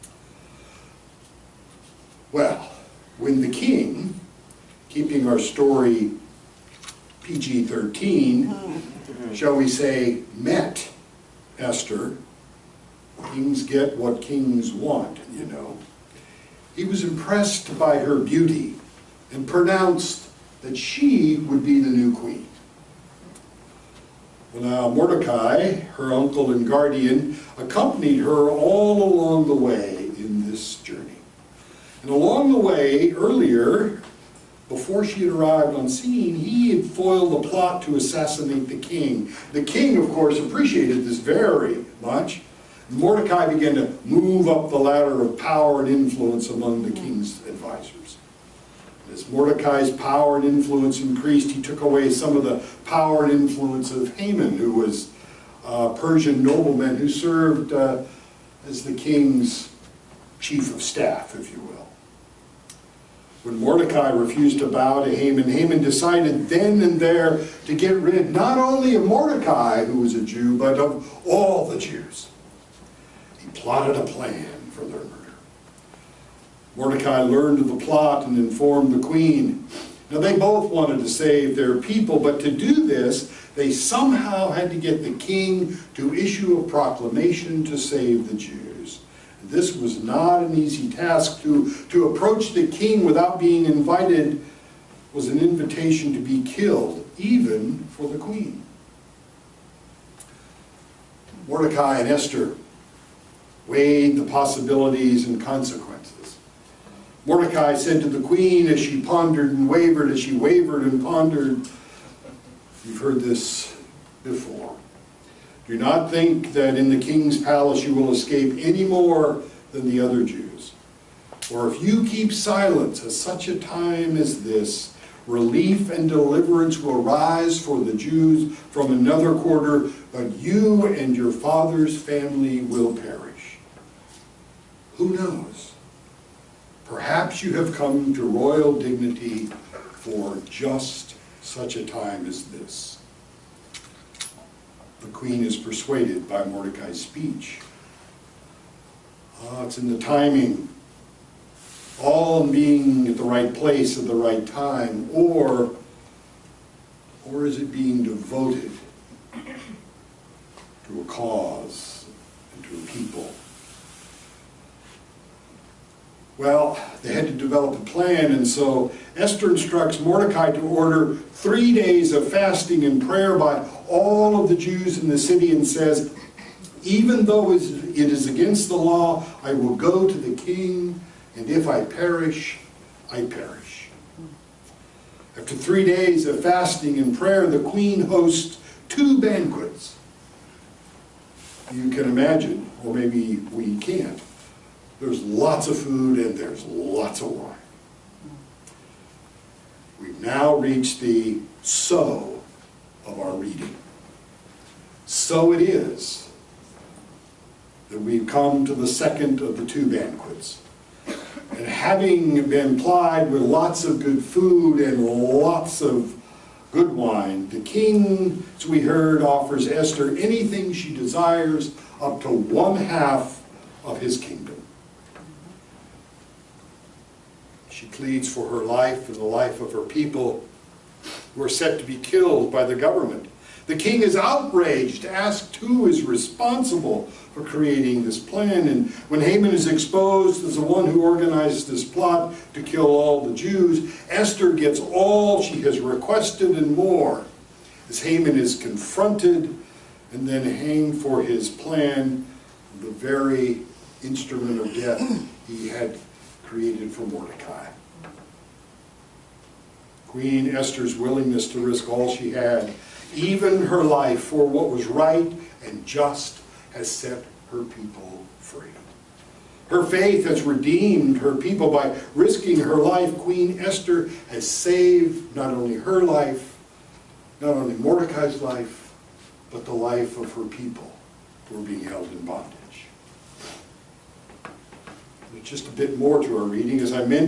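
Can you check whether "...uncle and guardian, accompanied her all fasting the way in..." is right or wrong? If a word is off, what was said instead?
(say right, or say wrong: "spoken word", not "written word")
wrong: "along", not "fasting".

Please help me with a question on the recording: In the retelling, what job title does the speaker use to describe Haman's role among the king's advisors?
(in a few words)
chief of staff.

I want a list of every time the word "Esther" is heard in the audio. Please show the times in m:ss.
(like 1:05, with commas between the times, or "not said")
0:11, 1:42, 2:49, 3:39, 4:04, 4:20, 4:33.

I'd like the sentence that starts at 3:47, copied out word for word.
She pleads for her life and the life of her people who are set to be killed by the government.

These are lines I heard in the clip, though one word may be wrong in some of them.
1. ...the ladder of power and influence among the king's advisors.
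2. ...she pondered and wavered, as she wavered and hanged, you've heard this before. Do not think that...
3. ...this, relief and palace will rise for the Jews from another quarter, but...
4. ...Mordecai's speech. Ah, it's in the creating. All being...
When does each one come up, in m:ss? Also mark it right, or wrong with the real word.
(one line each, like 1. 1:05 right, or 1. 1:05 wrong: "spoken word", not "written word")
1. 0:44 right
2. 1:48 wrong: "pondered", not "hanged"
3. 2:04 wrong: "deliverance", not "palace"
4. 2:26 wrong: "timing", not "creating".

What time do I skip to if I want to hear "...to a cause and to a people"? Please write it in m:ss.
2:39.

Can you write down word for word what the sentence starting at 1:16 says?
Mordecai learned of the plot and informed the queen.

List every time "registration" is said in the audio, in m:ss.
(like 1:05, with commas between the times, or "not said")
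not said.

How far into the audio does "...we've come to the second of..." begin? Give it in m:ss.
3:28.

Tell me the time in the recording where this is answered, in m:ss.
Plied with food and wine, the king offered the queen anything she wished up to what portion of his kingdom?
3:42.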